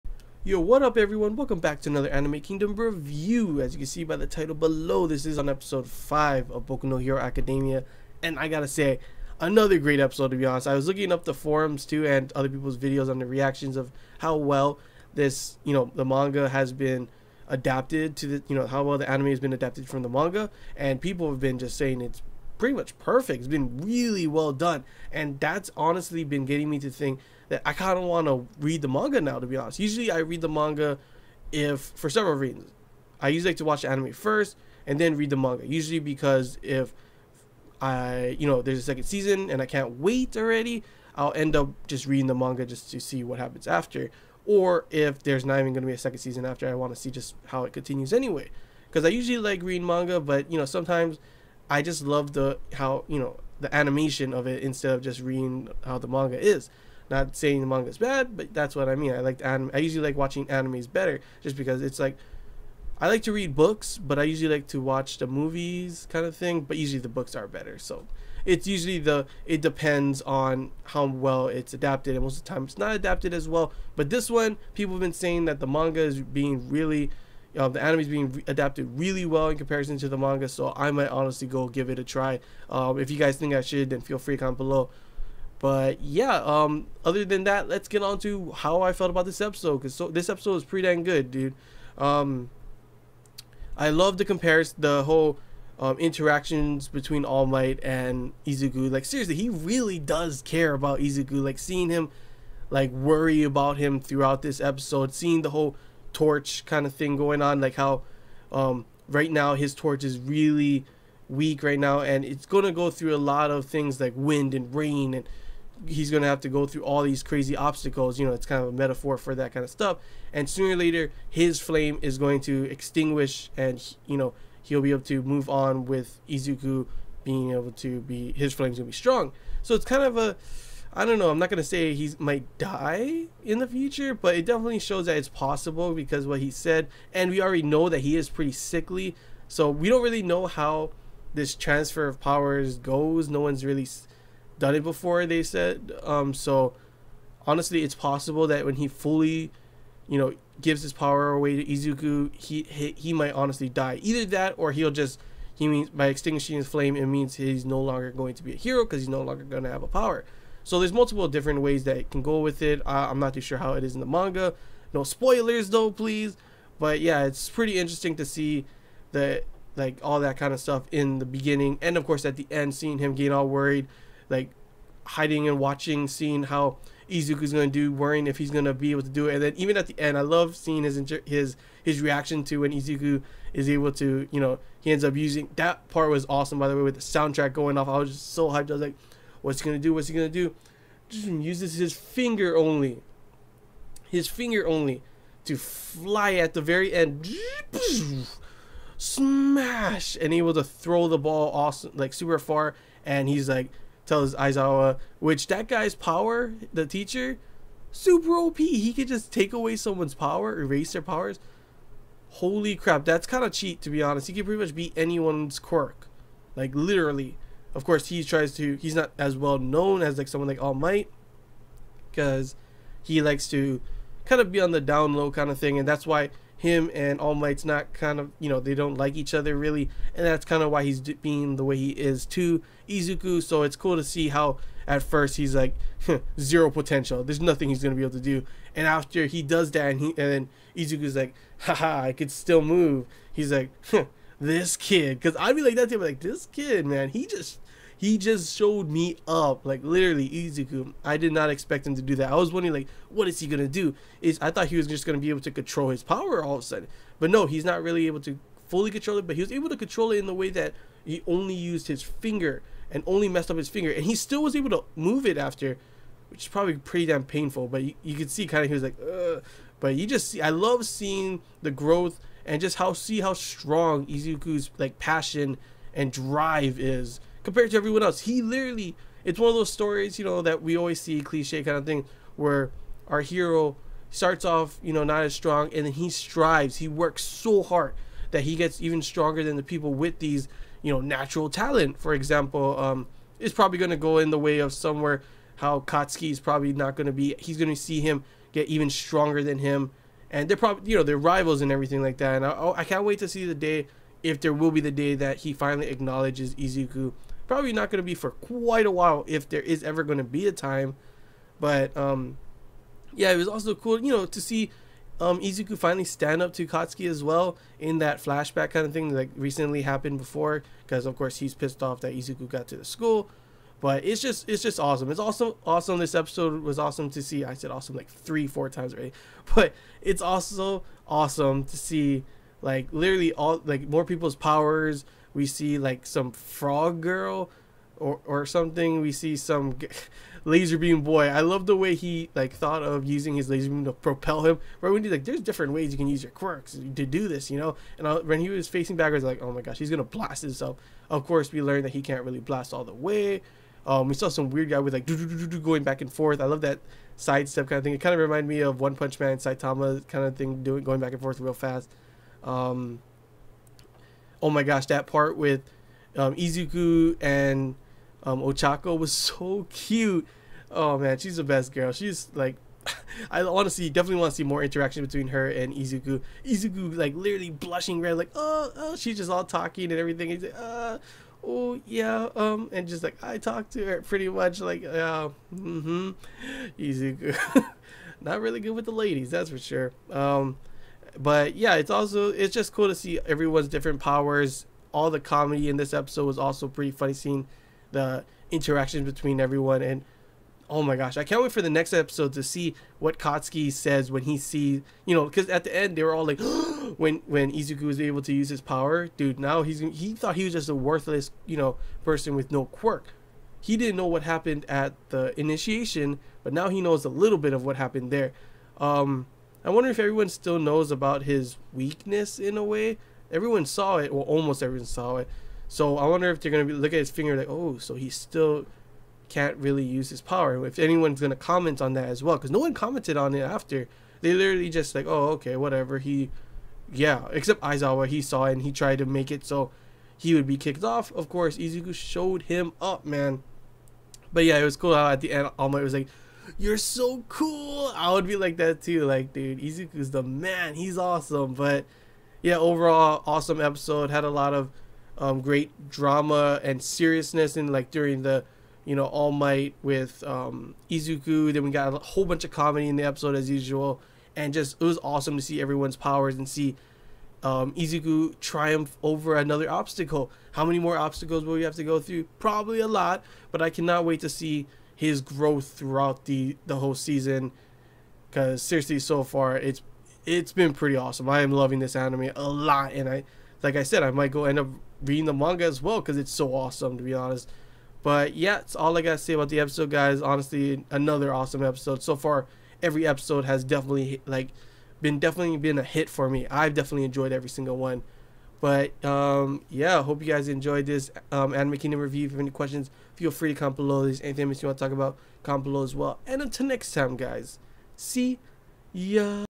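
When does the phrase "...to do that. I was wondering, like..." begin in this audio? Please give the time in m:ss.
4:11.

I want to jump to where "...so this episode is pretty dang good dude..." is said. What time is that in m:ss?
1:29.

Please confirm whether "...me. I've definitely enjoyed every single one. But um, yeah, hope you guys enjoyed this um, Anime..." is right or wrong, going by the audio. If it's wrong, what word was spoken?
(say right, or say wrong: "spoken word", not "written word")
right.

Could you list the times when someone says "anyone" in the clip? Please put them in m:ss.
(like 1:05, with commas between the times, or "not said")
3:34, 7:10.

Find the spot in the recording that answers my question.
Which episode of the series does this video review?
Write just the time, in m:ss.
0:05.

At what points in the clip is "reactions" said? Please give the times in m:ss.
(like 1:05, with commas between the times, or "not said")
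0:13, 3:02.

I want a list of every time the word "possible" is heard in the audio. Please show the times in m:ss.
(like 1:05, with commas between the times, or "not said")
2:15, 2:27.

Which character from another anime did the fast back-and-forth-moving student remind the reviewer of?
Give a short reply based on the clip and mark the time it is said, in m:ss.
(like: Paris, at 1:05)
Saitama, at 5:59.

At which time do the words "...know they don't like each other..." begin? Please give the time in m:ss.
3:48.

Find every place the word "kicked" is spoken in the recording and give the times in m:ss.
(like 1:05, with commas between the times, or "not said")
7:20.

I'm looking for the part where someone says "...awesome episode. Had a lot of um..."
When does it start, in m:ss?
7:33.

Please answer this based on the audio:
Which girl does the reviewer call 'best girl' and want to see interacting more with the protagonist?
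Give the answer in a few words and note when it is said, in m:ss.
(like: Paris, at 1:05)
Ochako, at 6:08.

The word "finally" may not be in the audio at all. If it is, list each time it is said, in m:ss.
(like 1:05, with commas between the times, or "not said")
5:05, 5:15.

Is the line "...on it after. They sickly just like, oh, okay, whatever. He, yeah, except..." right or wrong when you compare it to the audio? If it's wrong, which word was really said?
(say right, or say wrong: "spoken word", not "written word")
wrong: "literally", not "sickly".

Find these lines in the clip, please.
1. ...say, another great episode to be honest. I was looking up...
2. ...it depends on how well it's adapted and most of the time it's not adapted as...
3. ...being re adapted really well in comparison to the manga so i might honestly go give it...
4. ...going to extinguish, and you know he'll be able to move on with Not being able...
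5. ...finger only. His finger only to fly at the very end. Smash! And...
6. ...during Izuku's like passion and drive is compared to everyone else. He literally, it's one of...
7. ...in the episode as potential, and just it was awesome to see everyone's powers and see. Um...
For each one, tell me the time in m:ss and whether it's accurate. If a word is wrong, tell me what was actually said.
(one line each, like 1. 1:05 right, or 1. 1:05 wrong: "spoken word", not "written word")
1. 0:08 right
2. 1:09 right
3. 1:18 right
4. 2:02 wrong: "Izuku", not "Not"
5. 3:11 right
6. 4:33 wrong: "strong", not "during"
7. 7:42 wrong: "usual", not "potential".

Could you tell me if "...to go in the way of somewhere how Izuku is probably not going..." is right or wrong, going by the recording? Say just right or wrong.
wrong.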